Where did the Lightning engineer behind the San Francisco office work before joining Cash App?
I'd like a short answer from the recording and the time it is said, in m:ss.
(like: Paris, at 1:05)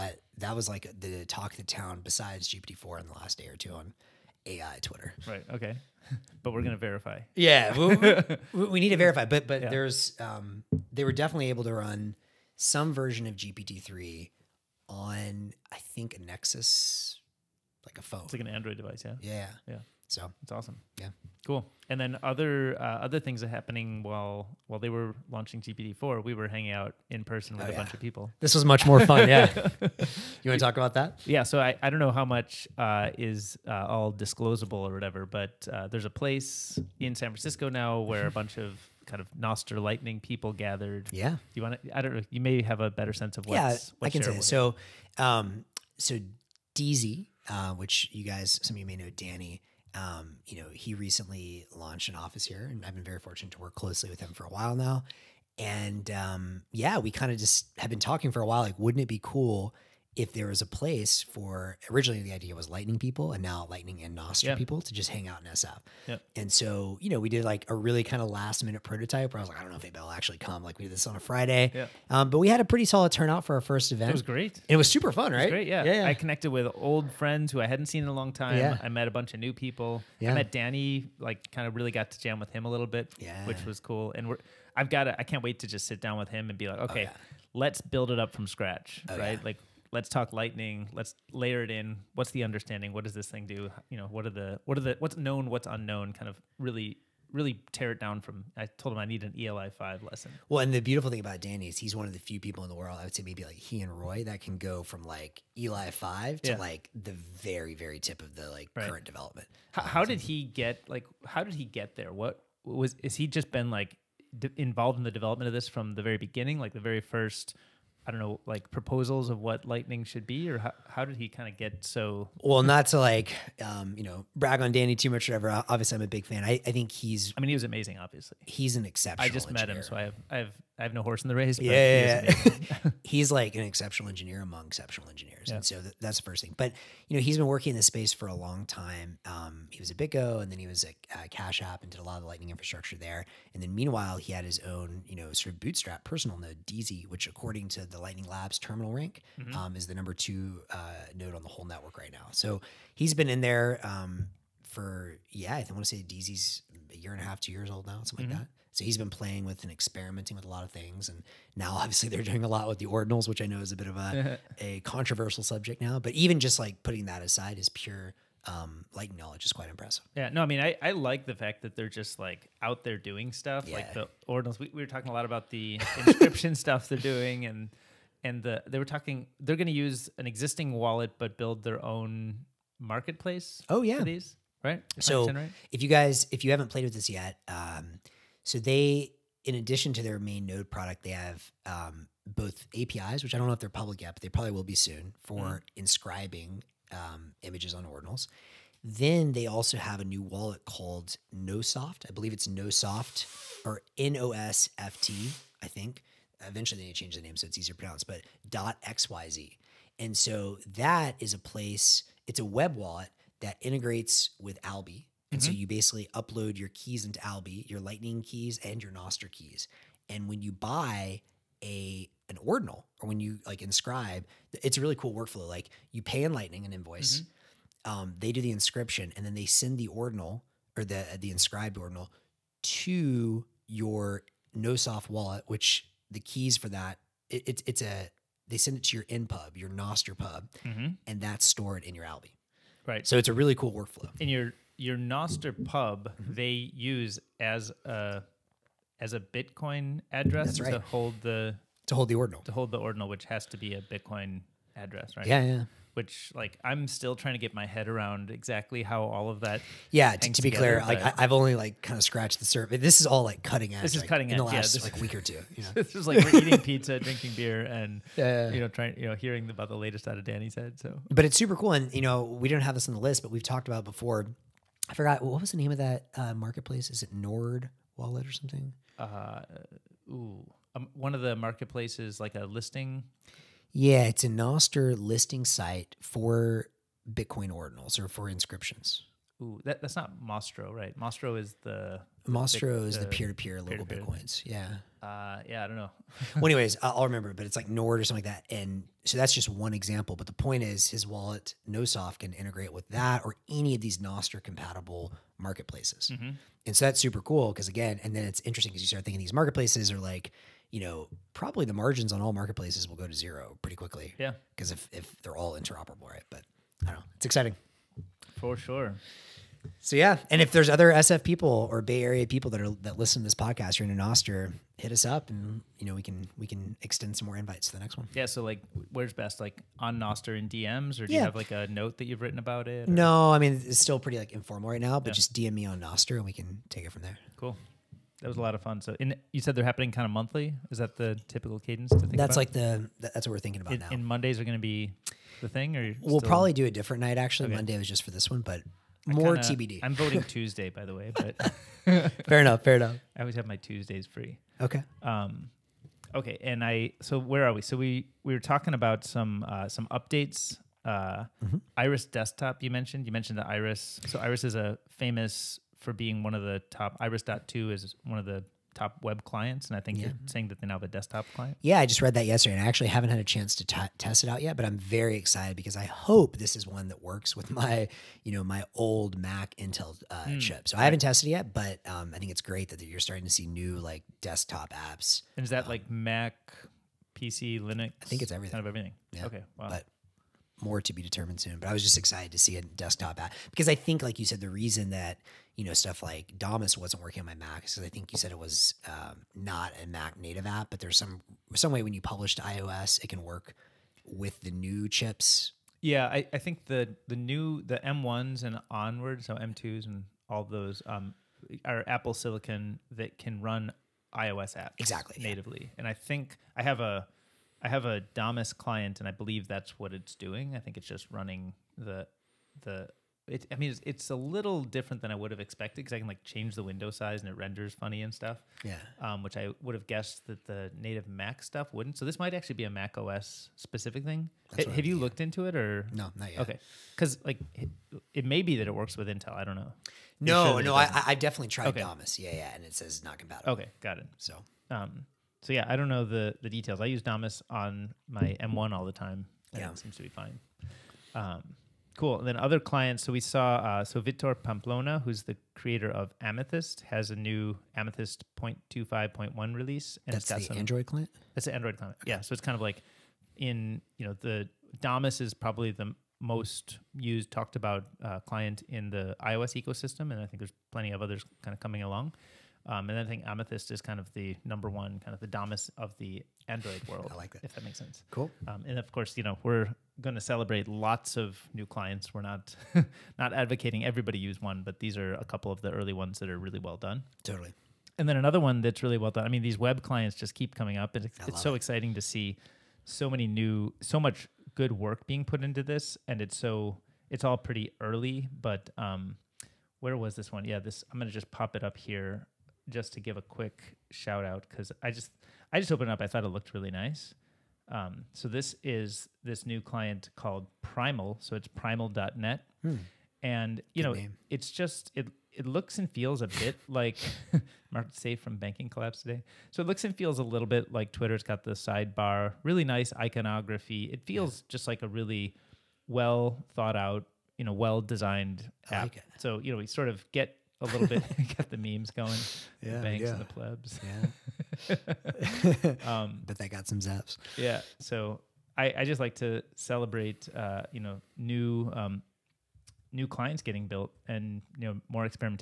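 BitGo, at 2:19.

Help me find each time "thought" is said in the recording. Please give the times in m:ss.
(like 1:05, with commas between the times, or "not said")
8:26, 8:46.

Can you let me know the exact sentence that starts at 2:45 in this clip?
But even just like putting that aside, is pure um, like knowledge is quite impressive.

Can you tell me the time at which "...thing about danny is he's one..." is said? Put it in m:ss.
1:41.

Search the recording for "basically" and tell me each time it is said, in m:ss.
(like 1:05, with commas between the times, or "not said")
3:35.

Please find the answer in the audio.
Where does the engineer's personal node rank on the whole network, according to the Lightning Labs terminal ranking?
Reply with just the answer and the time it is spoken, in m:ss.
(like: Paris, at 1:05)
number two, at 2:29.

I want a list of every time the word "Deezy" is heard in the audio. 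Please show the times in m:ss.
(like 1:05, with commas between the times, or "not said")
0:46, 2:26, 2:36.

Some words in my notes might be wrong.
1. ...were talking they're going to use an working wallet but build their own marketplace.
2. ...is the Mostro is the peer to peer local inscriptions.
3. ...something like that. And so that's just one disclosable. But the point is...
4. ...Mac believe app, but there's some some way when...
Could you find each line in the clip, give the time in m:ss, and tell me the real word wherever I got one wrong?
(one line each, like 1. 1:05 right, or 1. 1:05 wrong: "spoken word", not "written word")
1. 2:58 wrong: "existing", not "working"
2. 4:51 wrong: "bitcoins", not "inscriptions"
3. 4:58 wrong: "example", not "disclosable"
4. 6:39 wrong: "native", not "believe".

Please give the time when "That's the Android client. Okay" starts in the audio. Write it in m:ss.
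7:41.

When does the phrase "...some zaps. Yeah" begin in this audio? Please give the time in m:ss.
8:56.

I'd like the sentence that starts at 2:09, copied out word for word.
met him, so I have I have I have no horse in the race.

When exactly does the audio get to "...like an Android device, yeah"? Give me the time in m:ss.
0:18.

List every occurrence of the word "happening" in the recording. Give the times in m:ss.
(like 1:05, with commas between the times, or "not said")
0:23, 5:39.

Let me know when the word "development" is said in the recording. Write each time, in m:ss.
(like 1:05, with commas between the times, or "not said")
1:49, 1:55.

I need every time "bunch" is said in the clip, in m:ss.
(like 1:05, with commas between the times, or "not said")
0:27, 0:38, 1:19.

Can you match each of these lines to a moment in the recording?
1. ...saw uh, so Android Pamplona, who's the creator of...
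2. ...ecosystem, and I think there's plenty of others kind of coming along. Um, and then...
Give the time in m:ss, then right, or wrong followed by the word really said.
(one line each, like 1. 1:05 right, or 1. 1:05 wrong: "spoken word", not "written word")
1. 7:33 wrong: "Vitor", not "Android"
2. 7:49 right.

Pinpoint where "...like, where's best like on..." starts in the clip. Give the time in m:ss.
5:28.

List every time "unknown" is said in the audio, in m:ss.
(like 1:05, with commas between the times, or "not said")
1:35.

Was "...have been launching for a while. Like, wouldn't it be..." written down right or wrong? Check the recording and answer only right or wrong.
wrong.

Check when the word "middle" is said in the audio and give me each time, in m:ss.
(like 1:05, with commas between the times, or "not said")
not said.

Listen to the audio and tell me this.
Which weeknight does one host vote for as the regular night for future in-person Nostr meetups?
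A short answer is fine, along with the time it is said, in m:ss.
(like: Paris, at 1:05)
Tuesday, at 5:50.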